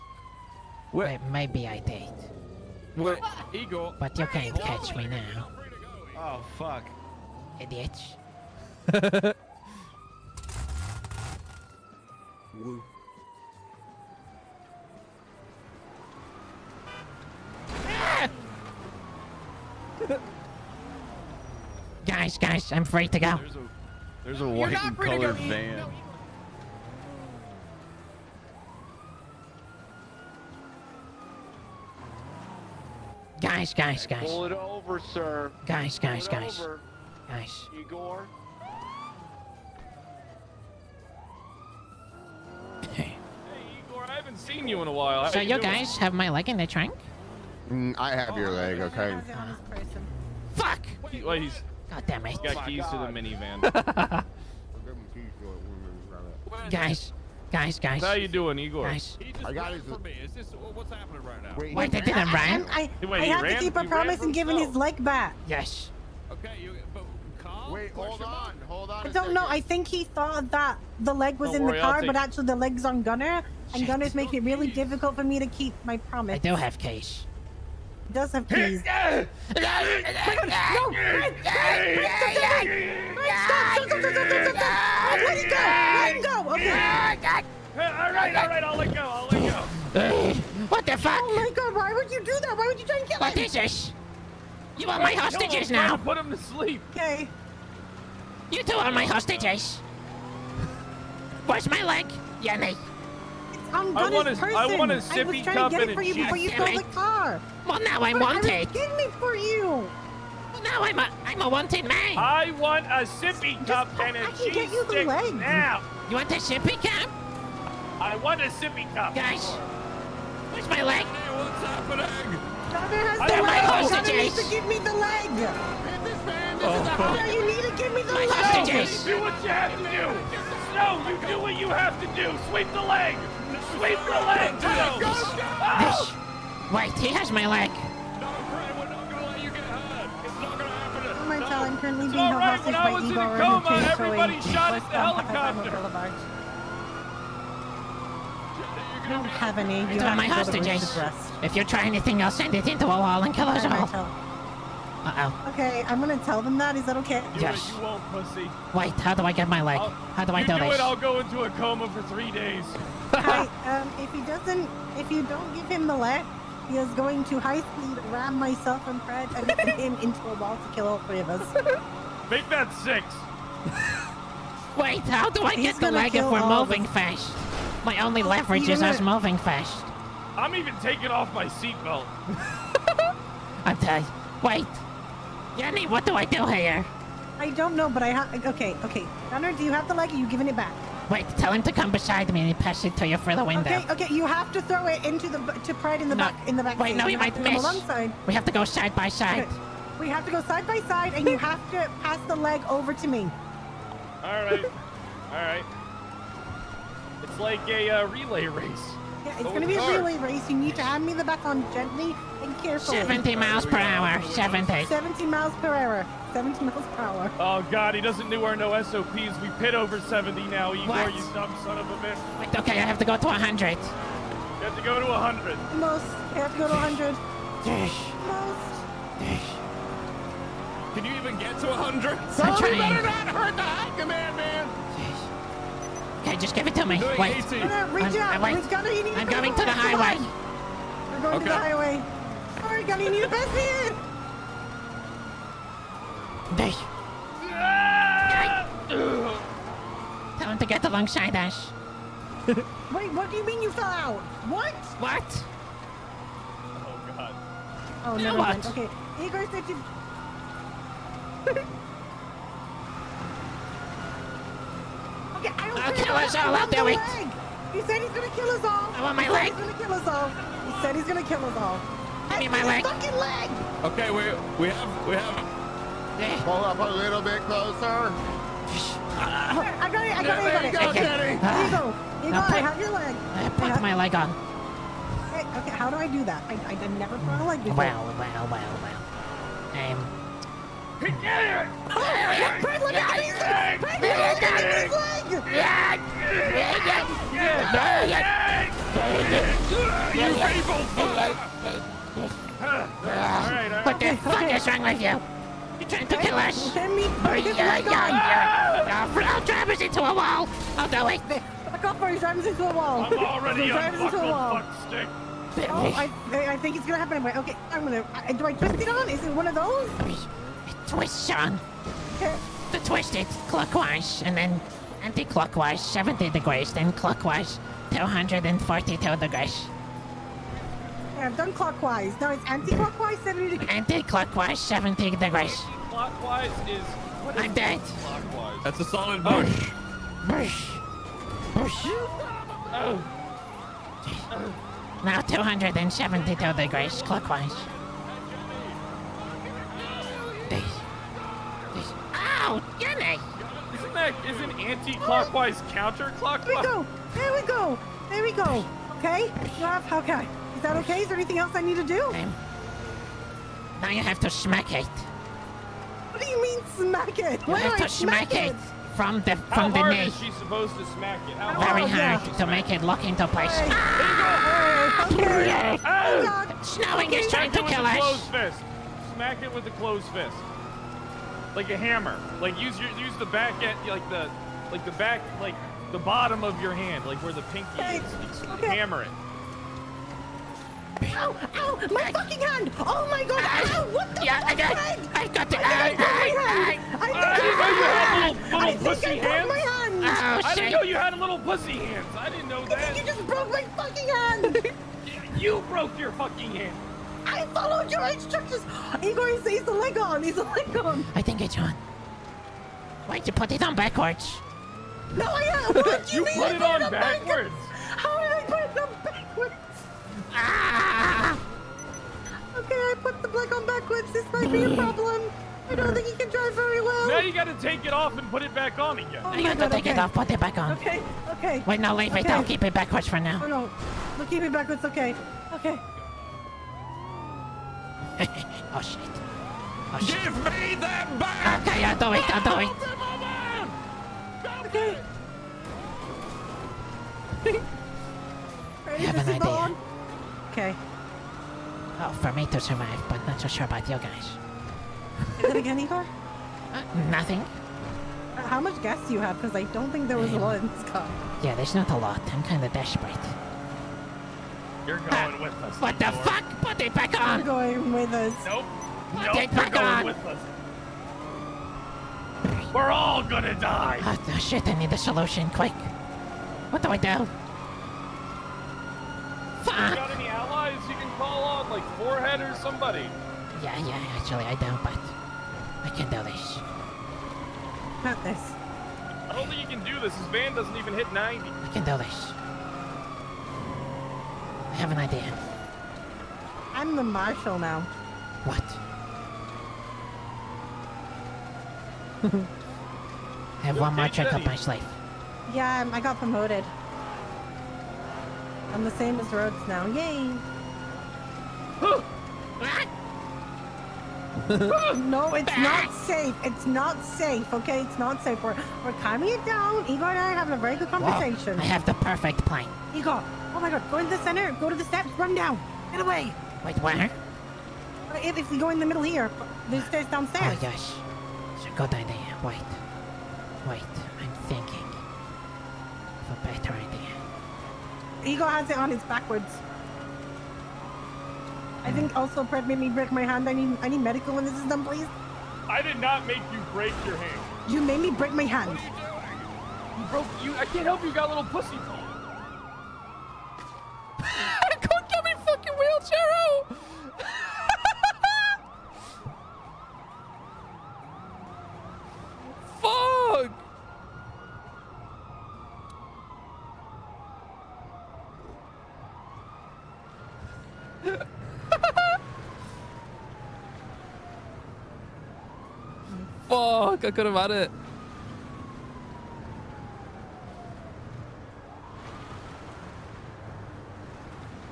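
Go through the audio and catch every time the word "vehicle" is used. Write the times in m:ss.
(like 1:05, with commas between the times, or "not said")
not said.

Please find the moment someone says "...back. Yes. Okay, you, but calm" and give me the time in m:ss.
1:05.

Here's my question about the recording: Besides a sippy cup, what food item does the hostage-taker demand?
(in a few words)
cheese.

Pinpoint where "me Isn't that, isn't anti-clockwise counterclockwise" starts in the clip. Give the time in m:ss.
5:52.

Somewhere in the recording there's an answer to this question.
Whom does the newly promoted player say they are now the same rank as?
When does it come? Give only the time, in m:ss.
8:29.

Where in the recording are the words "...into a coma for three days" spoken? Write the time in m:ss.
2:41.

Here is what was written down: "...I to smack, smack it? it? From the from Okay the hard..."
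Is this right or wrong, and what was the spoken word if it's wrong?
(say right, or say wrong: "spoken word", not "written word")
wrong: "How", not "Okay".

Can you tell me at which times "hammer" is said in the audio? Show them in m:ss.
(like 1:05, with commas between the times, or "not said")
6:21, 6:28.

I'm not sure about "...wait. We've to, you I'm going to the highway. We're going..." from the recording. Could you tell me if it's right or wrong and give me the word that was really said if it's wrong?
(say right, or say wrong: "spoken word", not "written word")
right.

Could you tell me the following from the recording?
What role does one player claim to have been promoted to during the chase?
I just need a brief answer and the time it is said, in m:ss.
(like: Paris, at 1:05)
marshal, at 8:17.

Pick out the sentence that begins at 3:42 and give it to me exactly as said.
Wait, okay, I have to go to 100.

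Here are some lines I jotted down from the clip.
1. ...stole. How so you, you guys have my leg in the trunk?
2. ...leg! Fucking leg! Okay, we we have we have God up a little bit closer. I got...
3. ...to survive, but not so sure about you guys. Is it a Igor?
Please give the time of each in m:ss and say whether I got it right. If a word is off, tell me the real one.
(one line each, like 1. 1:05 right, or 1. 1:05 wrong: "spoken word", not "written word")
1. 0:44 wrong: "while", not "stole"
2. 4:32 wrong: "Pull", not "God"
3. 7:32 right.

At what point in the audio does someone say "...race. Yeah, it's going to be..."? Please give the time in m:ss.
3:28.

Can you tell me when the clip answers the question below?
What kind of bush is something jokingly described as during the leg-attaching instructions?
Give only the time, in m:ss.
5:38.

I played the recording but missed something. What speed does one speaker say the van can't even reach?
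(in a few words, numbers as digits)
90.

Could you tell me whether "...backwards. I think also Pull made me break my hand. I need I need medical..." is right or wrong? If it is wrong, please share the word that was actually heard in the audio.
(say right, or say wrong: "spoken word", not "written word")
wrong: "Fred", not "Pull".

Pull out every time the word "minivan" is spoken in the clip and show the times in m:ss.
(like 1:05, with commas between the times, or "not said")
0:53.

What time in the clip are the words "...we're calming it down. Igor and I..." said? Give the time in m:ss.
8:38.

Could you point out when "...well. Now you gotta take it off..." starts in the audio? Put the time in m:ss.
7:06.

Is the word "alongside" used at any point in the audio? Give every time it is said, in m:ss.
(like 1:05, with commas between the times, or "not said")
3:17, 4:10.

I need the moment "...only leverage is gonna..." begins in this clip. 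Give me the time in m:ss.
2:58.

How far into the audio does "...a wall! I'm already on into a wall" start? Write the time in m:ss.
5:12.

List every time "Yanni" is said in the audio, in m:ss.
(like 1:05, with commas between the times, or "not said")
1:42, 3:05.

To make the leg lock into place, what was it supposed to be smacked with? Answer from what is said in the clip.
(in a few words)
closed fist.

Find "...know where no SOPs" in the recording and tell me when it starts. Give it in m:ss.
3:38.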